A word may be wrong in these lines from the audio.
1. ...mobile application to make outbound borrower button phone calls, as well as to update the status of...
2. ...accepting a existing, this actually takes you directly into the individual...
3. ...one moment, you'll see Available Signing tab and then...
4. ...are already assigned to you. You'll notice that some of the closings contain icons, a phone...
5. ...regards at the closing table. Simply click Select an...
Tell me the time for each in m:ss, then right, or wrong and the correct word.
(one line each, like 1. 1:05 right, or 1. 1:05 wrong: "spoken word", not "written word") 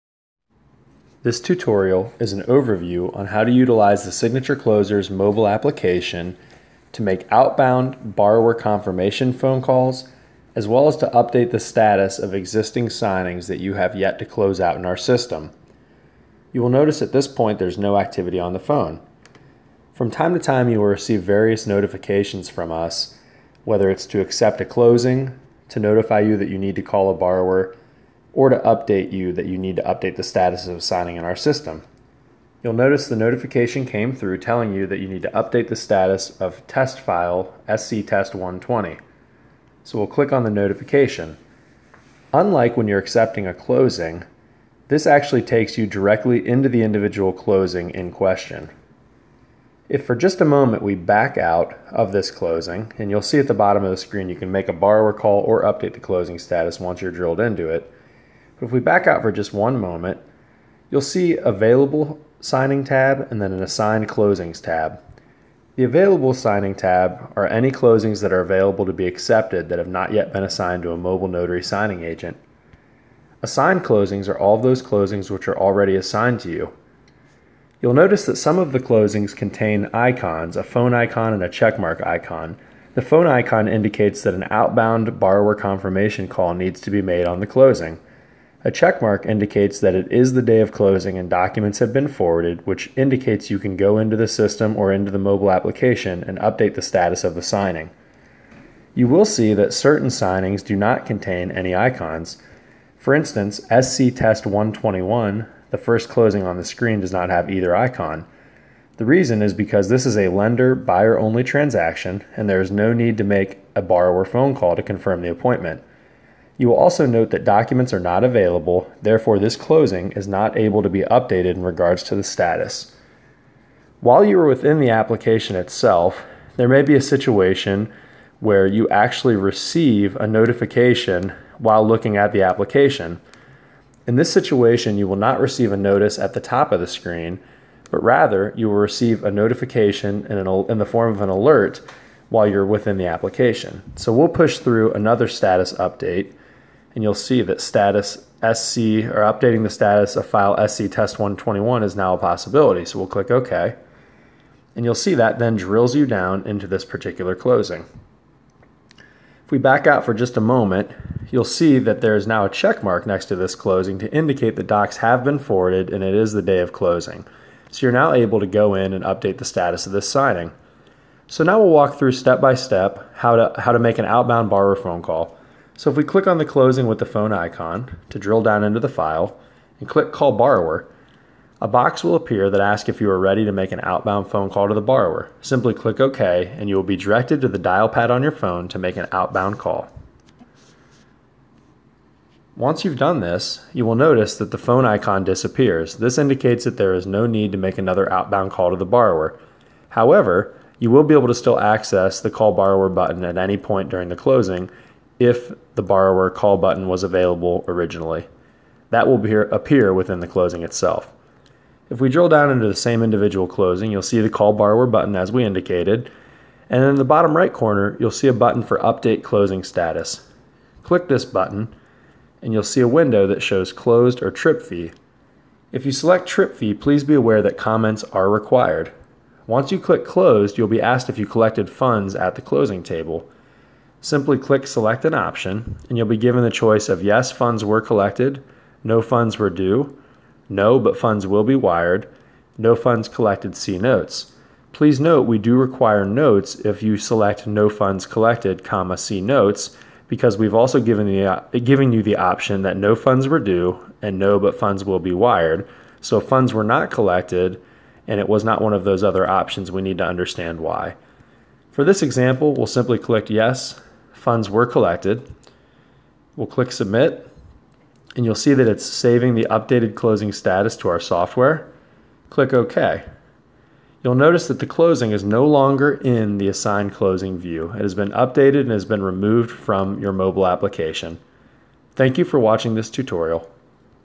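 1. 0:05 wrong: "confirmation", not "button"
2. 0:42 wrong: "closing", not "existing"
3. 0:59 right
4. 1:15 right
5. 3:51 wrong: "funds", not "regards".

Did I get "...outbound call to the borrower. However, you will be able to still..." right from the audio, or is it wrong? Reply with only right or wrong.
right.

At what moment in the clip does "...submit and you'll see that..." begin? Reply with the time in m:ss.
4:26.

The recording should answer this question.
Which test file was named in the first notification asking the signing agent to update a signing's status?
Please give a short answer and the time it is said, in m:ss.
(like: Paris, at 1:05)
SC Test 120, at 0:37.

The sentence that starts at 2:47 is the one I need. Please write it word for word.
So you're now able to go in and update the status of this signing.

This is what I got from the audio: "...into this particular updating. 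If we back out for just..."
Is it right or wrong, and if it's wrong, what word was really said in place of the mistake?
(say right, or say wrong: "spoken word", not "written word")
wrong: "closing", not "updating".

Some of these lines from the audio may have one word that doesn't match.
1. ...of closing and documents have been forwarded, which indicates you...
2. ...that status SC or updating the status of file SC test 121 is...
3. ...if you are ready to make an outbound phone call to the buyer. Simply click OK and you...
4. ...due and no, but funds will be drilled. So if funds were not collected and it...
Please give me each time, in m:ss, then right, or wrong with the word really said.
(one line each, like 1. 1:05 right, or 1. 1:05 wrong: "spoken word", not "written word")
1. 1:30 right
2. 2:27 right
3. 3:02 wrong: "borrower", not "buyer"
4. 4:13 wrong: "wired", not "drilled".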